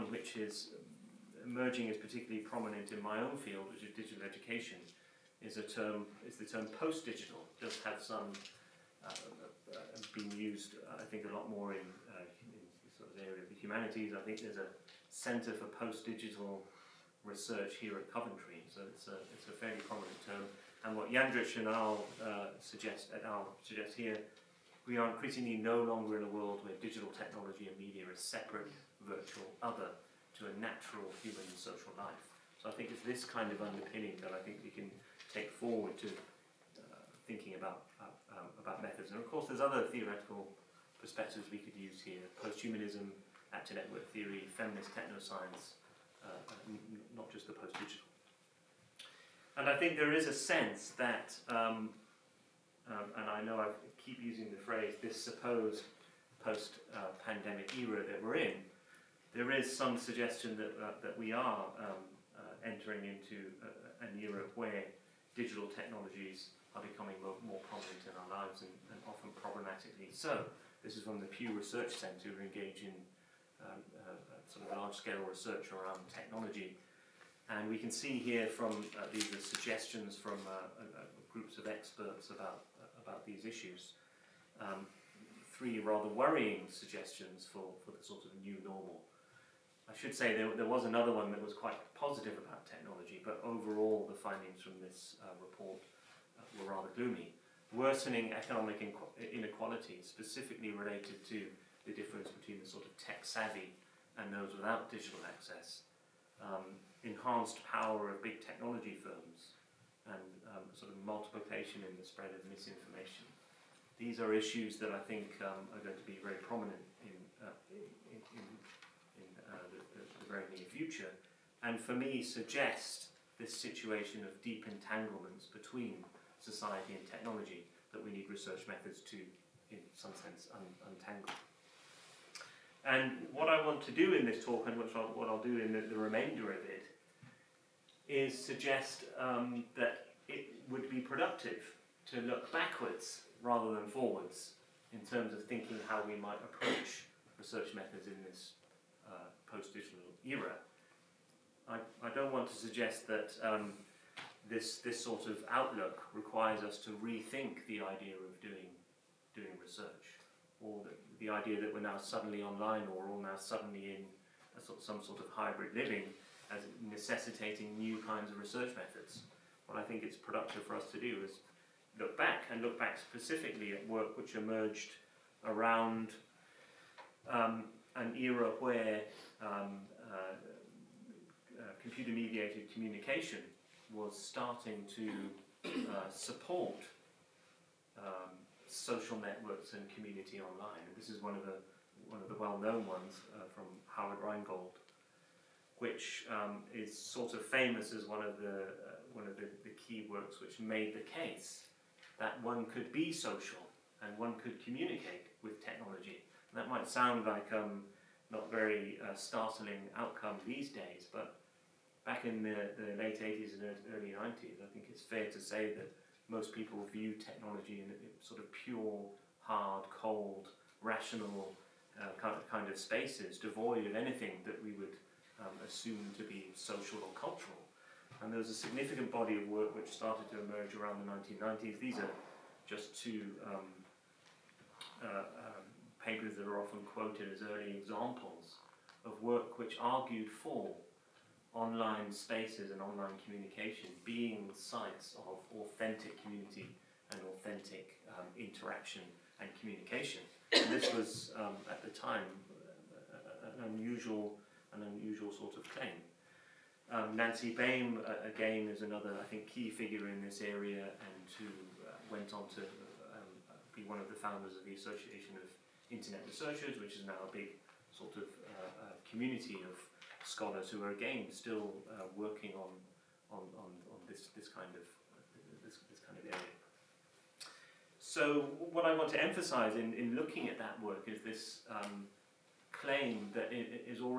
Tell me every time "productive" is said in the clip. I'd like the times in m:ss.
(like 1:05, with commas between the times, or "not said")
2:20, 2:50.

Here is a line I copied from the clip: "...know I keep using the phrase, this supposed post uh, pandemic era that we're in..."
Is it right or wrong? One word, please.
right.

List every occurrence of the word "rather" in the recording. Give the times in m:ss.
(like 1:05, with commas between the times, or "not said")
1:25, 1:36, 2:23.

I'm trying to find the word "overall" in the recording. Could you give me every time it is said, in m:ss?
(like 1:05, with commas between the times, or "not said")
1:33.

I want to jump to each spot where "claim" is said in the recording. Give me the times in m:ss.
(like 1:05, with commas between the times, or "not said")
4:15, 4:42.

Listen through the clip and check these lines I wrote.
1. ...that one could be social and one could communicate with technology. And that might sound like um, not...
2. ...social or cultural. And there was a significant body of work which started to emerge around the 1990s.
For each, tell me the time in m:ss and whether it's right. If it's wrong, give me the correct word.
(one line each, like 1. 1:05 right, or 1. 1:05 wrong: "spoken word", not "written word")
1. 3:22 right
2. 3:46 right.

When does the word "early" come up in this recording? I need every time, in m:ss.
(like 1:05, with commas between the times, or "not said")
3:33, 3:57.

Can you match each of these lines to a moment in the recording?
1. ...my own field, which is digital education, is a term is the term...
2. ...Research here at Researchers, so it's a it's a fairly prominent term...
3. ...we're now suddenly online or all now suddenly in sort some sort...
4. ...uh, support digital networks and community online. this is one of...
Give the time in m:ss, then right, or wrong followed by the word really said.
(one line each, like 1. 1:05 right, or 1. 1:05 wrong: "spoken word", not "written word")
1. 0:03 right
2. 0:17 wrong: "Coventry", not "Researchers"
3. 2:41 right
4. 3:05 wrong: "social", not "digital".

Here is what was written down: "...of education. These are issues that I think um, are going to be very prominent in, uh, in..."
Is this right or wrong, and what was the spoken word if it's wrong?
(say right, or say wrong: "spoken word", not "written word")
wrong: "misinformation", not "education".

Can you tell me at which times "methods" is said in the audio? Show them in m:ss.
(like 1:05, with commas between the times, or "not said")
0:38, 2:08, 2:27, 2:48.